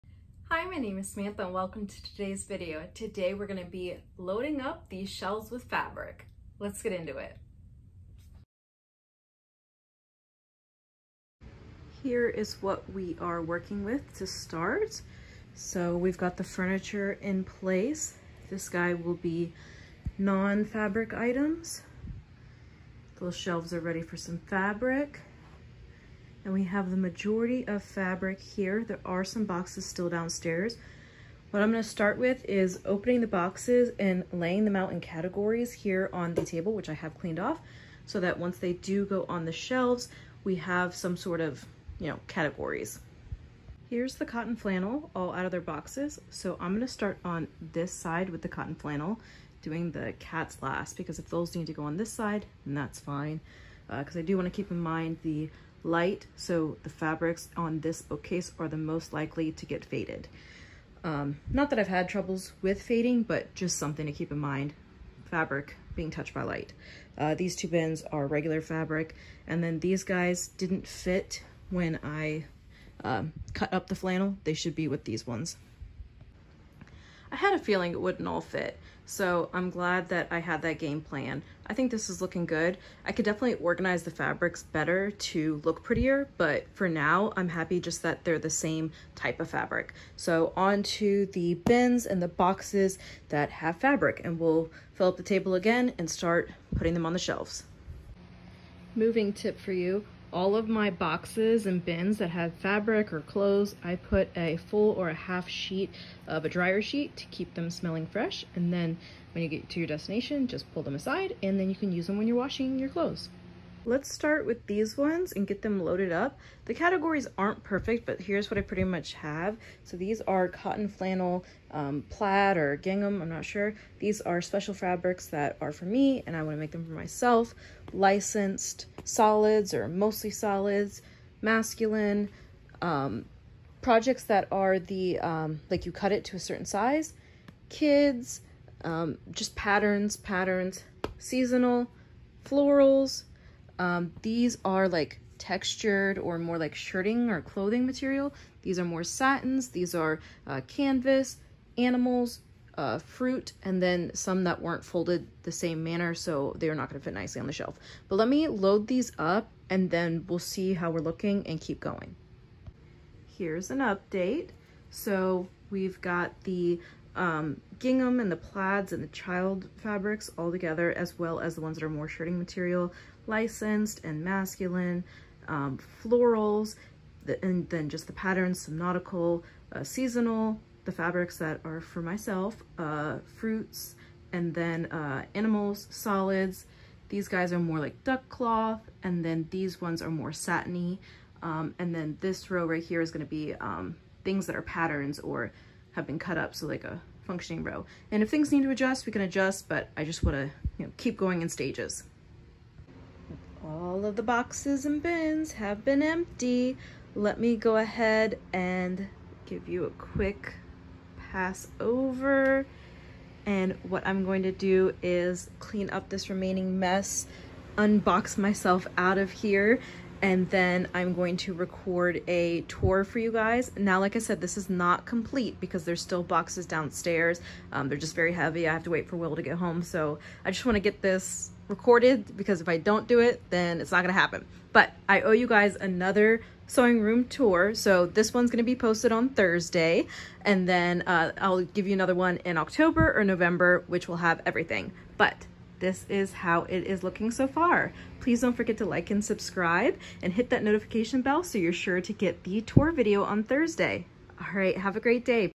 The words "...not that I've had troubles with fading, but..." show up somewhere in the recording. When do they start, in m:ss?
1:01.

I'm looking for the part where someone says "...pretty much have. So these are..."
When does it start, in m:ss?
1:58.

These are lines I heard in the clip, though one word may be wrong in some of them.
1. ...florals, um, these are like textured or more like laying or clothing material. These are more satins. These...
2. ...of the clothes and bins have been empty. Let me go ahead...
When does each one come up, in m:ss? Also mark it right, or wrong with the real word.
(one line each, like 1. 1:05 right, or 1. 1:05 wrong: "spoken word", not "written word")
1. 2:22 wrong: "shirting", not "laying"
2. 3:24 wrong: "boxes", not "clothes".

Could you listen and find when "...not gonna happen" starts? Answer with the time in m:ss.
3:53.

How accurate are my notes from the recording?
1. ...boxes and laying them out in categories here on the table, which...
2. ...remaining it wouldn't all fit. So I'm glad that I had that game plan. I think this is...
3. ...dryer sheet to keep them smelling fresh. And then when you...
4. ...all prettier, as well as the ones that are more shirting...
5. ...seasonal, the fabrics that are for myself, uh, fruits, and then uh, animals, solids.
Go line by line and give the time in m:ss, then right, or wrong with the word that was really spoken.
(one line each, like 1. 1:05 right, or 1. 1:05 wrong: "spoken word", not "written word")
1. 0:33 right
2. 1:17 wrong: "feeling", not "remaining"
3. 1:46 right
4. 2:50 wrong: "together", not "prettier"
5. 2:59 right.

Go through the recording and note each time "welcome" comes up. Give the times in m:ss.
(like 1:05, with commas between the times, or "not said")
0:01.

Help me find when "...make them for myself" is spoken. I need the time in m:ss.
2:06.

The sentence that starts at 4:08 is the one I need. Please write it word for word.
Please don't forget to like and subscribe and hit that notification bell so you're sure to get the tour video on Thursday.